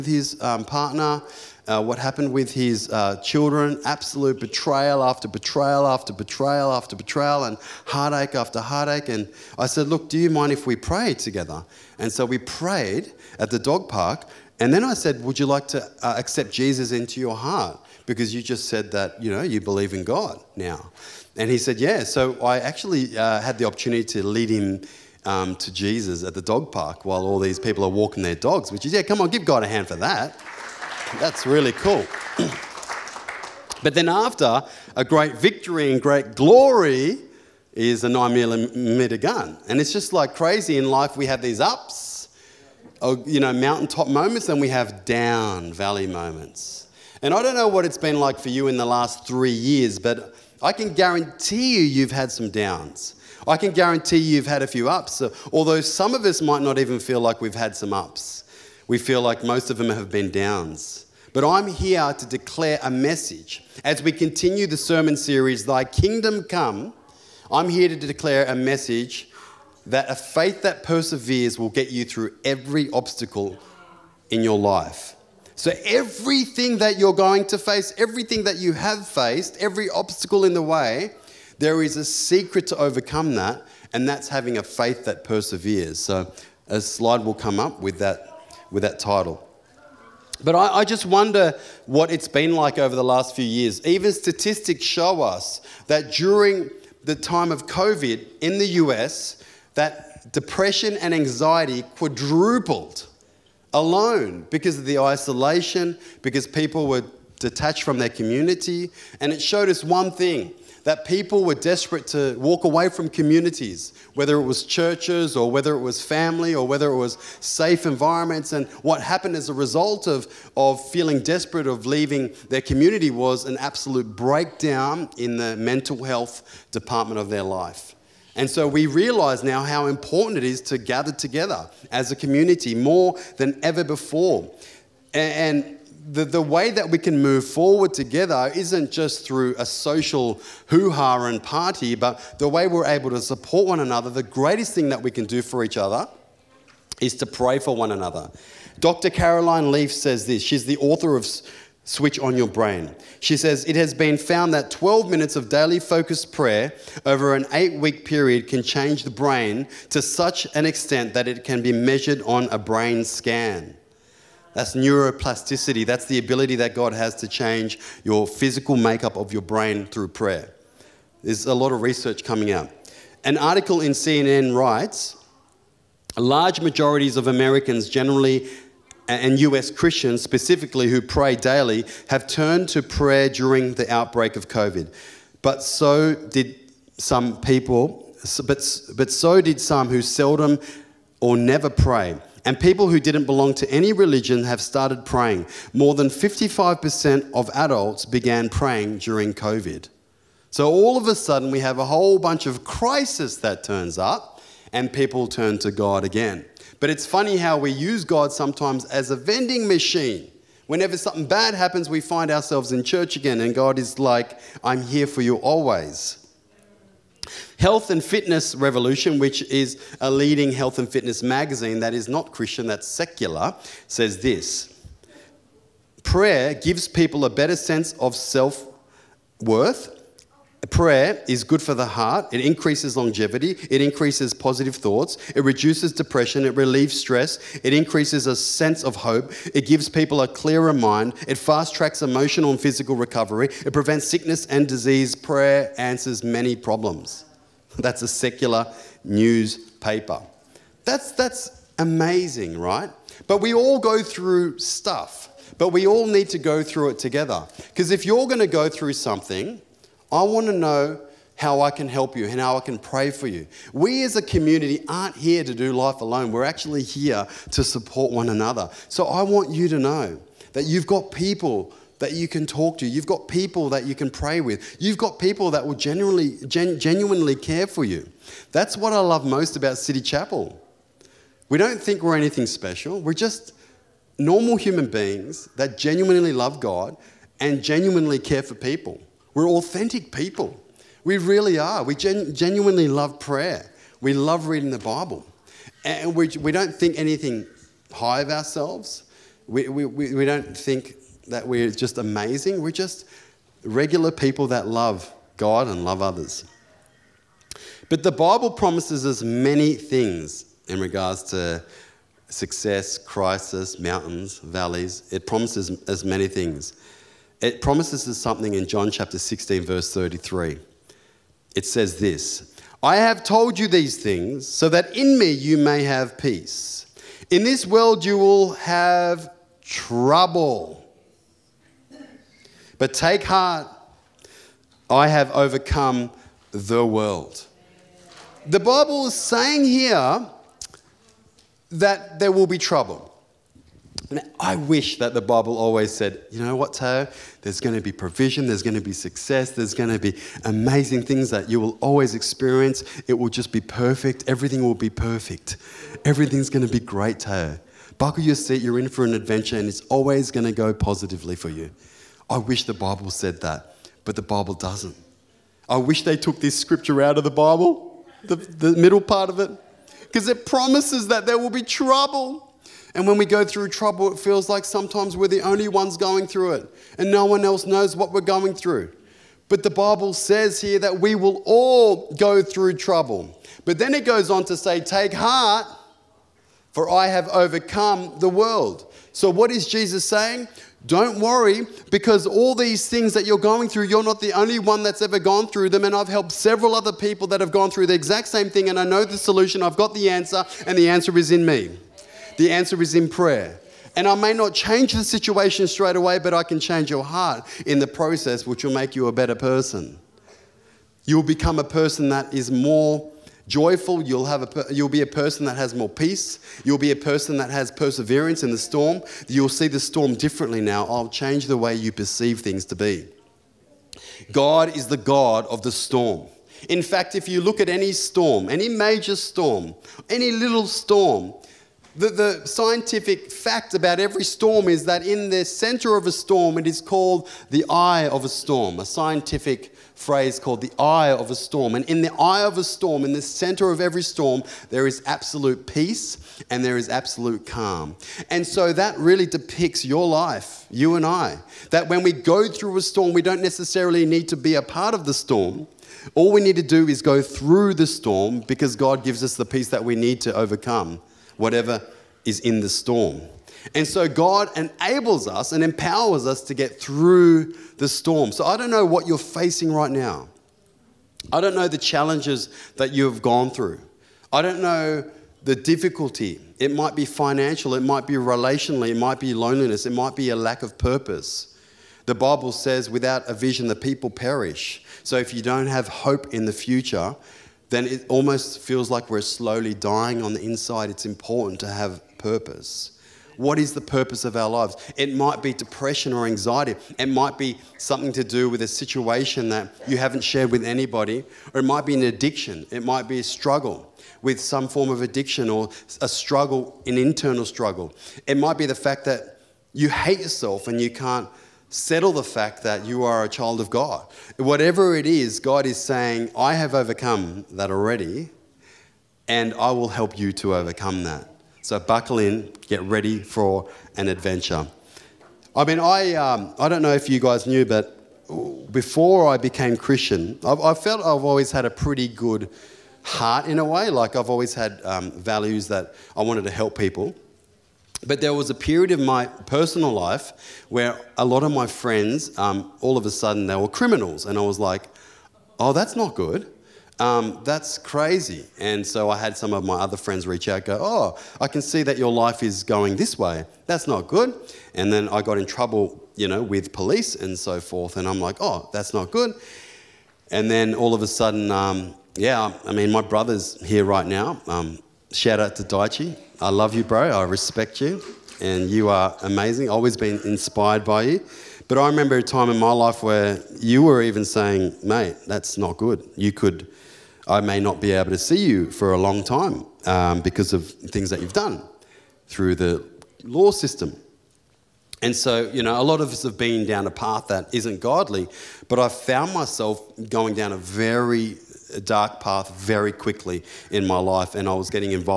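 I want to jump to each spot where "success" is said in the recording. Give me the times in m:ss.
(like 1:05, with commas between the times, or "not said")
5:12, 5:48.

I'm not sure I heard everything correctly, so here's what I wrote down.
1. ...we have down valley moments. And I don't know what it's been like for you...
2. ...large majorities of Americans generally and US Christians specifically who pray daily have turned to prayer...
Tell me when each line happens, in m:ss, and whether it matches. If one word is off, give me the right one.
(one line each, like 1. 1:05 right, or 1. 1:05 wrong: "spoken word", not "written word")
1. 0:44 right
2. 2:56 right.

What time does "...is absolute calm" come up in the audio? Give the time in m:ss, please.
7:26.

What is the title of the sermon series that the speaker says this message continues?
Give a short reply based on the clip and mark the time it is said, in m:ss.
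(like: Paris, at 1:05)
Thy Kingdom Come, at 1:05.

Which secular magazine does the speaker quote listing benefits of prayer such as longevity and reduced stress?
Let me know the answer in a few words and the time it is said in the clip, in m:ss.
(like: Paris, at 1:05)
Health and Fitness Revolution, at 3:37.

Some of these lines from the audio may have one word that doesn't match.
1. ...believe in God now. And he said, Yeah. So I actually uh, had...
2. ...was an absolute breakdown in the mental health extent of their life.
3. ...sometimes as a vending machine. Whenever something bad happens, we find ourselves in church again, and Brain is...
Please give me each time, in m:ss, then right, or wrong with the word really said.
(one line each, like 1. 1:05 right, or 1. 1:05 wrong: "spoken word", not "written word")
1. 0:19 right
2. 2:03 wrong: "department", not "extent"
3. 3:28 wrong: "God", not "Brain".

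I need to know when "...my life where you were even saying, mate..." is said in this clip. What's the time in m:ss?
9:32.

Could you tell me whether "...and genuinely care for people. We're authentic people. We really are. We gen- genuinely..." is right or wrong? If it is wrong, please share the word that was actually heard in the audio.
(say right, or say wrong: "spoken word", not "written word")
right.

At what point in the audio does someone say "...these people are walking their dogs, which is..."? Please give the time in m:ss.
0:27.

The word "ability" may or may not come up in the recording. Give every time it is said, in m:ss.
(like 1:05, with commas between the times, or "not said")
2:46.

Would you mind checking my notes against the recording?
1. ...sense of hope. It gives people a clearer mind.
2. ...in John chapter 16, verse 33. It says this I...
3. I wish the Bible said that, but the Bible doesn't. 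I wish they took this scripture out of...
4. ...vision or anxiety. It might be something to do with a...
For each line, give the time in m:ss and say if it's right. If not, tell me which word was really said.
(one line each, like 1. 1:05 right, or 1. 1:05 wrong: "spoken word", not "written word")
1. 3:58 right
2. 5:18 right
3. 6:02 right
4. 8:15 wrong: "depression", not "vision".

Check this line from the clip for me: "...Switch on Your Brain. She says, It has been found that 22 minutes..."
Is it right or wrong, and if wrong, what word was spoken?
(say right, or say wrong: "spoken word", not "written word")
wrong: "12", not "22".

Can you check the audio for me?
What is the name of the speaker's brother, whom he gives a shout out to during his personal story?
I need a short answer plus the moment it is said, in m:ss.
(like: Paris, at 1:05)
Daichi, at 9:25.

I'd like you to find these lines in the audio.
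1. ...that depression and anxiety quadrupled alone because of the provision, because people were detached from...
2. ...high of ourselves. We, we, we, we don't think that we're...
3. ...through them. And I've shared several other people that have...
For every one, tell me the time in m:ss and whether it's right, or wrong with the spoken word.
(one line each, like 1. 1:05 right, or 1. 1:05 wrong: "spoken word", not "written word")
1. 1:39 wrong: "isolation", not "provision"
2. 4:57 right
3. 6:35 wrong: "helped", not "shared".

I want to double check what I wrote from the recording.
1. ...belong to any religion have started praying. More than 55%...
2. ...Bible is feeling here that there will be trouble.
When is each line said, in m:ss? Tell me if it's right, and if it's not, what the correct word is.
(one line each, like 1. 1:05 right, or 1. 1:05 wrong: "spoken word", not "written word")
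1. 3:13 right
2. 5:38 wrong: "saying", not "feeling".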